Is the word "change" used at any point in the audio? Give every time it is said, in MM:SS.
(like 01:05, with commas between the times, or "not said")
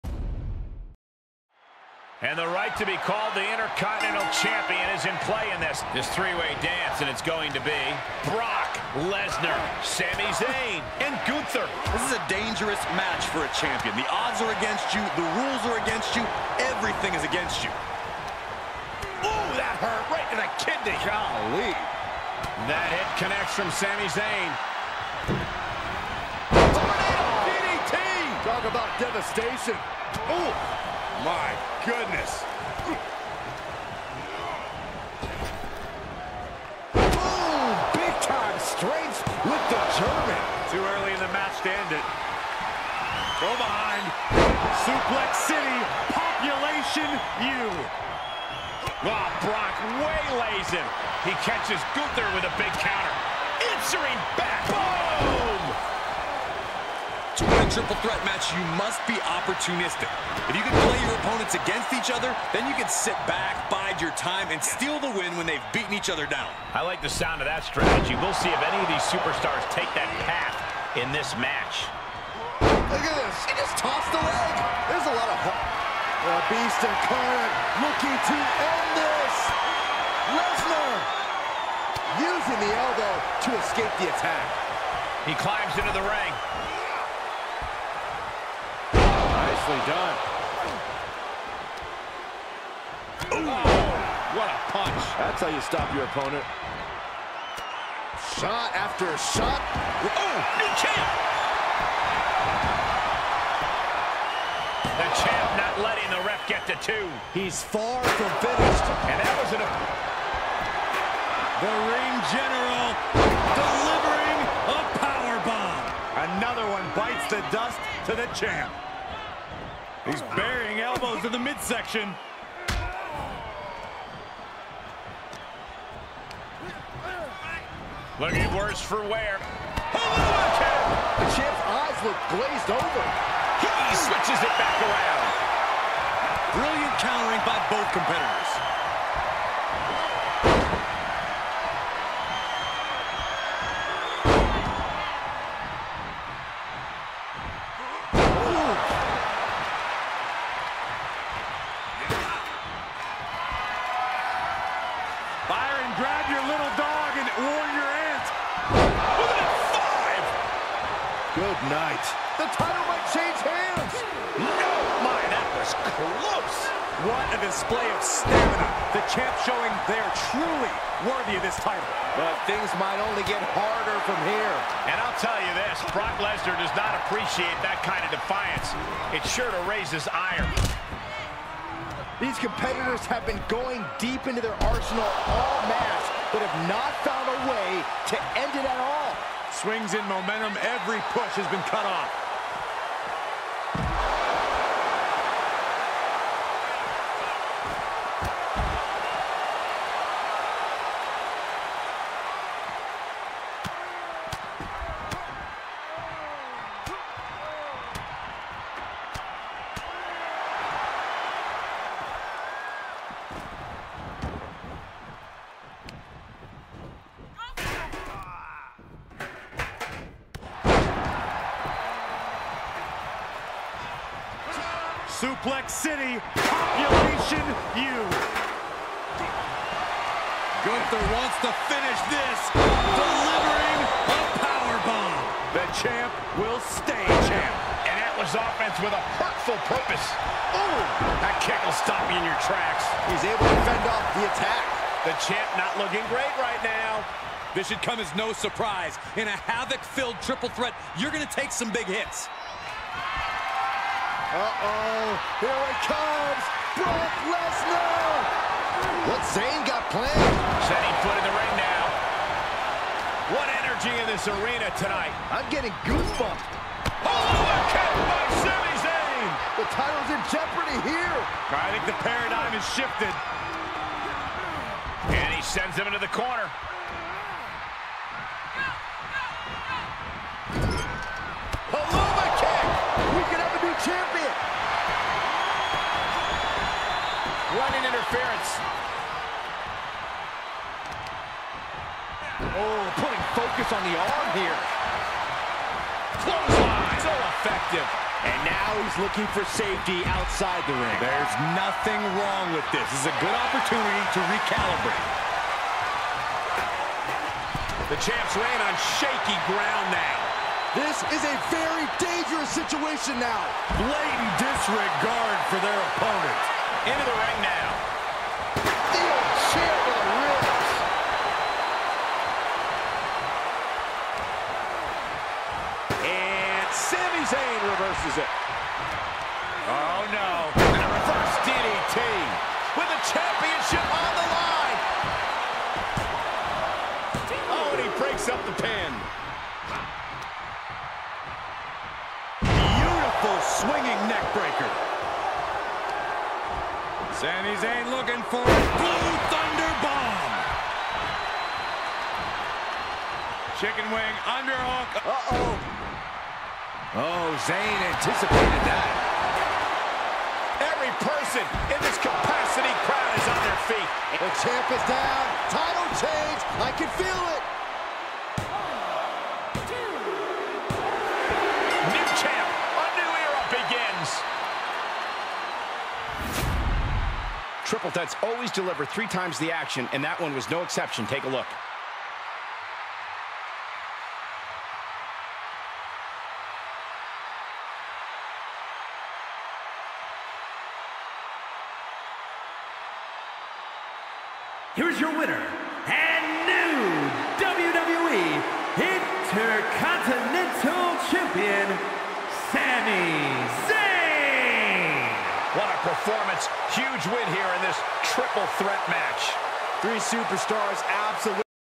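02:43, 06:06.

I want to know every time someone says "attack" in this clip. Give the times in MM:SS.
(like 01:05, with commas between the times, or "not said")
01:24, 04:04.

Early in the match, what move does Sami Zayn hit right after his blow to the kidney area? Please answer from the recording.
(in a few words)
Tornado DDT.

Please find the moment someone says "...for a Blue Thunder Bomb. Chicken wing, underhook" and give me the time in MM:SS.
05:48.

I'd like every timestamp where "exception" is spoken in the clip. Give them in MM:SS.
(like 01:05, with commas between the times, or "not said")
06:20.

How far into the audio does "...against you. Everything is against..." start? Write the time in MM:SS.
00:15.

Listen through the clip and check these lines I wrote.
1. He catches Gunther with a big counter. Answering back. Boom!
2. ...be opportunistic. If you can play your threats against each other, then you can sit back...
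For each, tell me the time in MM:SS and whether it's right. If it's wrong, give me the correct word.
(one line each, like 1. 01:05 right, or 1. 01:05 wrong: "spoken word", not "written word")
1. 00:51 right
2. 00:59 wrong: "opponents", not "threats".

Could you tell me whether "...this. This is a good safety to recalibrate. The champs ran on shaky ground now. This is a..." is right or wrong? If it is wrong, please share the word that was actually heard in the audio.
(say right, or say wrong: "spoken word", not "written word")
wrong: "opportunity", not "safety".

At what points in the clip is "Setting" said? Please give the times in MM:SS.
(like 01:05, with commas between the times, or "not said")
04:20.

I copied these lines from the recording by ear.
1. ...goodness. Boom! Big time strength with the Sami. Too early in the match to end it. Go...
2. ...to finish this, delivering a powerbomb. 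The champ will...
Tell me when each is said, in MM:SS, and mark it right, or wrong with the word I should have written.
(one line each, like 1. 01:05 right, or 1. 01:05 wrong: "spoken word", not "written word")
1. 00:31 wrong: "German", not "Sami"
2. 03:51 right.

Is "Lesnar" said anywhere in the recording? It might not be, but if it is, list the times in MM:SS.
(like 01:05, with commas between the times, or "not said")
00:09, 01:20, 02:56, 04:17.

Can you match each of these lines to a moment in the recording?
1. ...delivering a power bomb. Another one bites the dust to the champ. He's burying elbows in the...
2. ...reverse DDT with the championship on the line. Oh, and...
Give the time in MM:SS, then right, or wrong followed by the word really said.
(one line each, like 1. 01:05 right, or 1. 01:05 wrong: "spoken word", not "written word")
1. 01:53 right
2. 05:30 right.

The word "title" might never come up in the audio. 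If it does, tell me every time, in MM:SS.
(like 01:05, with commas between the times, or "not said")
02:42, 02:51, 04:29, 06:05.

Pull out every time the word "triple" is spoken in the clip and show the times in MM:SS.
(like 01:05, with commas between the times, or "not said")
00:57, 04:10, 06:17, 06:48.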